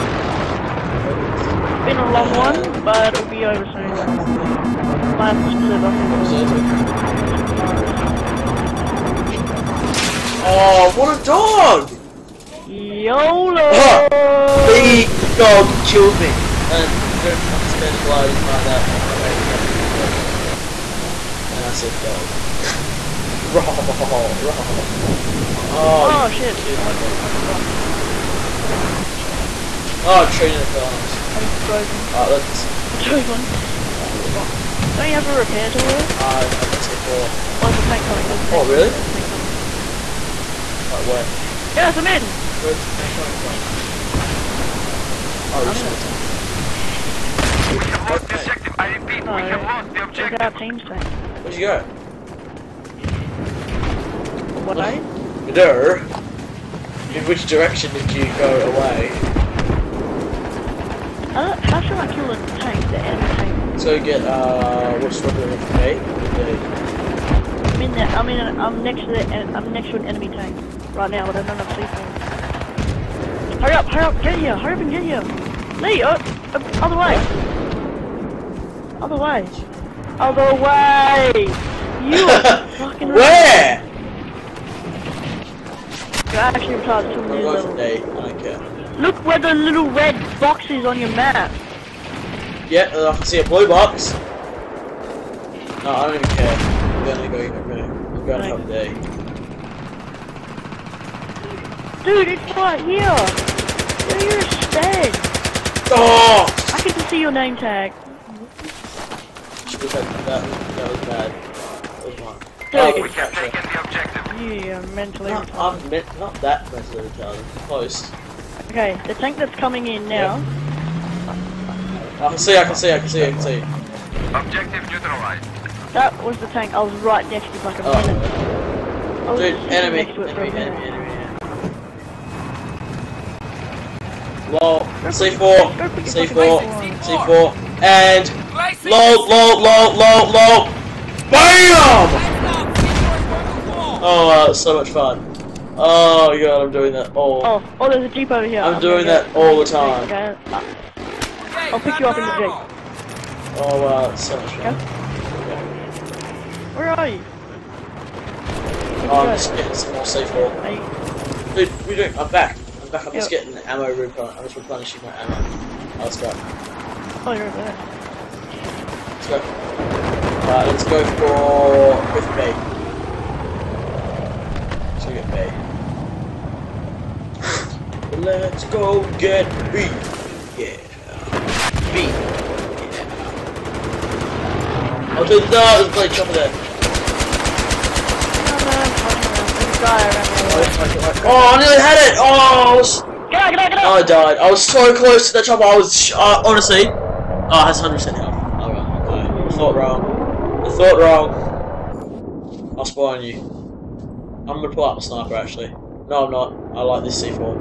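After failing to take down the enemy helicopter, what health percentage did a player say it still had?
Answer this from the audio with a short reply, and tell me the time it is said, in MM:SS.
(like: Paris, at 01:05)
100%, at 03:17.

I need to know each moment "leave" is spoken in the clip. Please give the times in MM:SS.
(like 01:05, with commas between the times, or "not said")
not said.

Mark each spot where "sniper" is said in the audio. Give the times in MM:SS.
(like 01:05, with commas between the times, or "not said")
03:25.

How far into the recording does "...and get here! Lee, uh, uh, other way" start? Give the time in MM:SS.
01:14.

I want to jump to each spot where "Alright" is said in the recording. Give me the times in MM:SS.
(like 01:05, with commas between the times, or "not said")
00:32, 02:50, 03:18.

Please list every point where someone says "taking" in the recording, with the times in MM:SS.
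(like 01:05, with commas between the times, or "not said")
01:53.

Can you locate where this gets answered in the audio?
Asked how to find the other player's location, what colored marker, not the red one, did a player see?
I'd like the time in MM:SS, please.
01:33.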